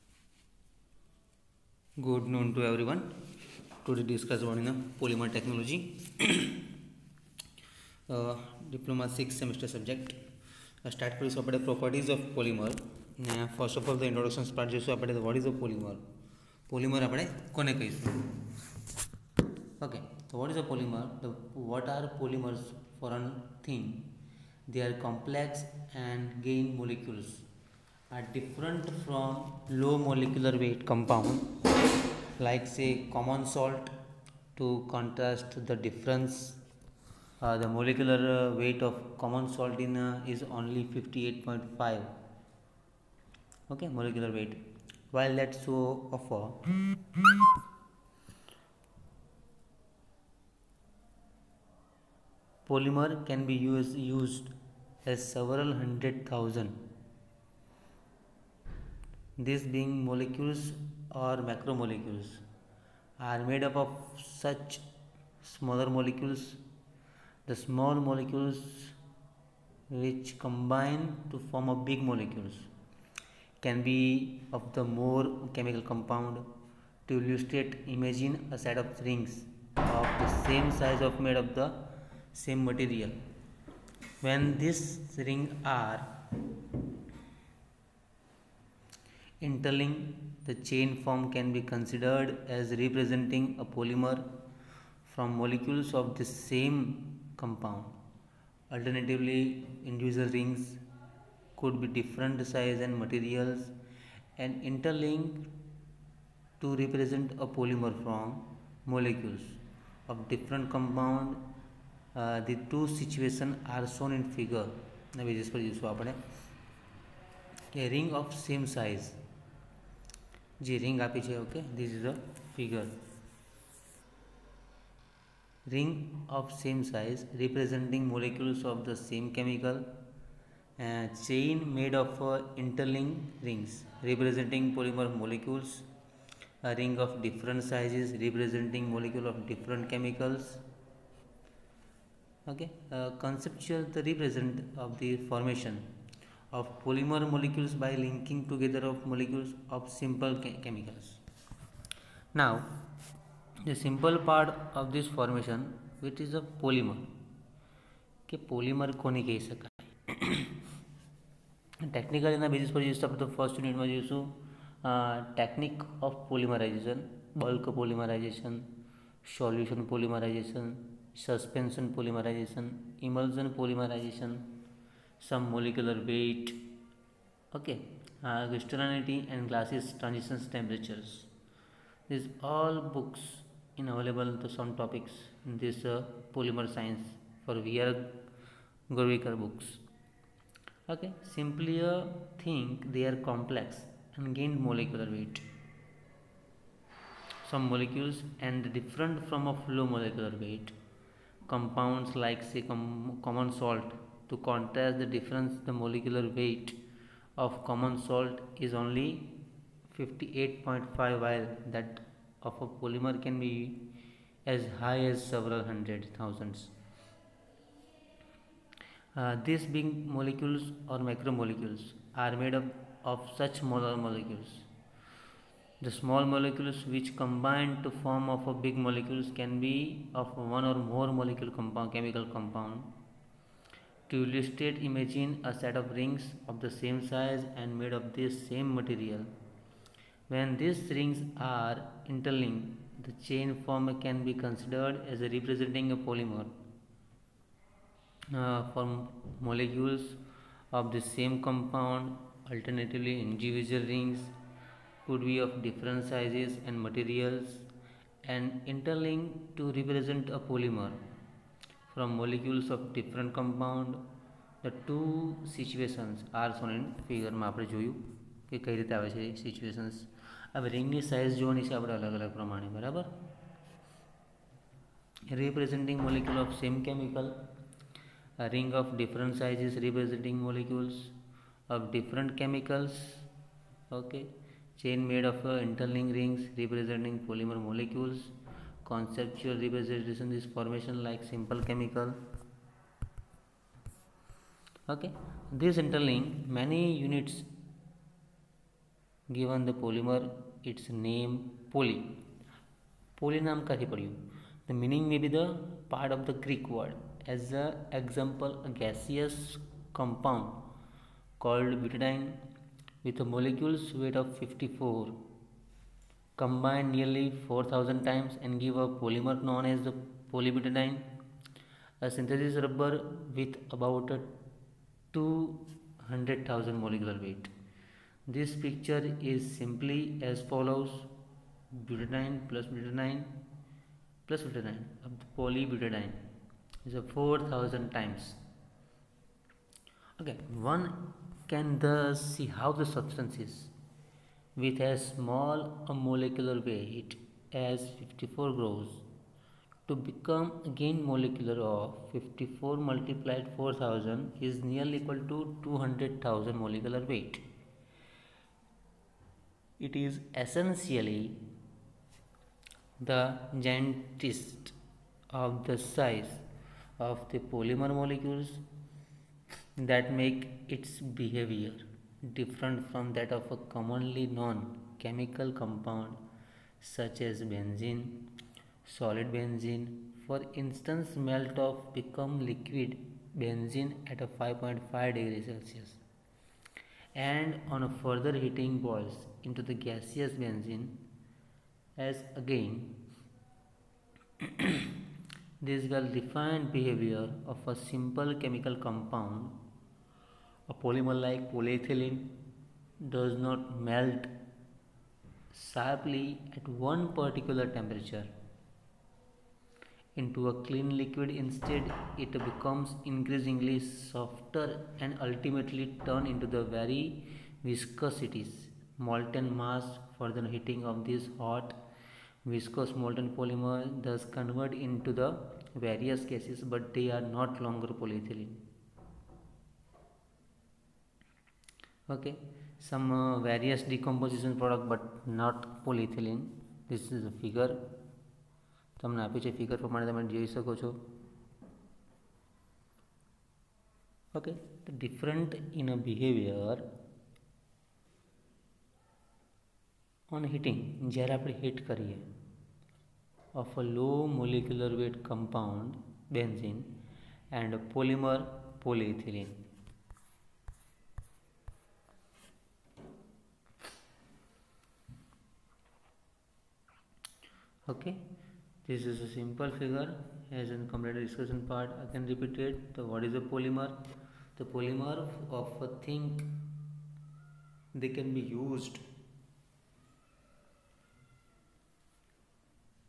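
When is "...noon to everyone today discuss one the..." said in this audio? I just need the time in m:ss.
0:02.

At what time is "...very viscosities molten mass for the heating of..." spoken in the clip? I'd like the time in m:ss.
6:56.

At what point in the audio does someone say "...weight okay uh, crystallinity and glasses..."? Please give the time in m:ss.
2:56.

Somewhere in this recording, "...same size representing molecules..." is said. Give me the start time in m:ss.
2:06.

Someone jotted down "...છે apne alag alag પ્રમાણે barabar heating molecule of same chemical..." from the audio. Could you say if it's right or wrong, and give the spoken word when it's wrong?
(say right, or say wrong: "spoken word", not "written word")
wrong: "representing", not "heating".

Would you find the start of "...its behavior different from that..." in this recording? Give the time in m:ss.
6:10.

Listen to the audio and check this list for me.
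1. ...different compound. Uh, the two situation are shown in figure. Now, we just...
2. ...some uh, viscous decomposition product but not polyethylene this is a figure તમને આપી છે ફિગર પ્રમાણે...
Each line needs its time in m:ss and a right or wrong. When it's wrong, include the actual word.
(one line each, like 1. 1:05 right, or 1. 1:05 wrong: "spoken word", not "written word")
1. 1:50 right
2. 7:12 wrong: "various", not "viscous".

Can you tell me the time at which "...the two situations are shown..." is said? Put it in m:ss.
4:24.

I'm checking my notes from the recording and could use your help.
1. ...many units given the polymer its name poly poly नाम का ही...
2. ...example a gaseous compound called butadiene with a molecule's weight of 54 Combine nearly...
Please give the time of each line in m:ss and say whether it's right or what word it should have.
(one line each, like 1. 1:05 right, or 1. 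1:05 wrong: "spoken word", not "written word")
1. 4:56 right
2. 5:07 right.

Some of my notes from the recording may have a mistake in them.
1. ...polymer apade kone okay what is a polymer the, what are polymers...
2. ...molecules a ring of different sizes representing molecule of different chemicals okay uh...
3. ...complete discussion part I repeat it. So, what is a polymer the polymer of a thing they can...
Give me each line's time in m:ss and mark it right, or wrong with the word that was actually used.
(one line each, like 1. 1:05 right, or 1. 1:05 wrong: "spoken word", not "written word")
1. 0:16 right
2. 2:15 right
3. 7:50 right.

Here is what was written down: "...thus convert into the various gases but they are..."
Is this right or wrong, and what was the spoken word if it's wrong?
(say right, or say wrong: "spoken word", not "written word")
right.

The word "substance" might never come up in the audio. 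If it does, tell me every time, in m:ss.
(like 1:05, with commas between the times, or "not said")
5:42.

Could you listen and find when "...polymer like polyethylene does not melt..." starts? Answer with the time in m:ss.
6:40.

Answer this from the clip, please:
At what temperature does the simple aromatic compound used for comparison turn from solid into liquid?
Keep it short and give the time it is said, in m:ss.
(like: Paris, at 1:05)
5.5 °C, at 6:24.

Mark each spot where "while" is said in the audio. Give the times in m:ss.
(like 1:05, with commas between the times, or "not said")
0:45, 3:31.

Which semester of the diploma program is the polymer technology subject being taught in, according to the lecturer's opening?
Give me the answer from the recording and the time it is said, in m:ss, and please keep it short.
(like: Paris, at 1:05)
6th semester, at 0:09.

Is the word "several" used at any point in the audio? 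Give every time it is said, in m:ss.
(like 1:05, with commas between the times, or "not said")
0:55, 3:35.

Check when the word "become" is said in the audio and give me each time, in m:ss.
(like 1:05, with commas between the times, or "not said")
5:49, 6:21, 6:52.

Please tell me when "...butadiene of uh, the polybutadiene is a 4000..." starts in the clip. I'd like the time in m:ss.
5:34.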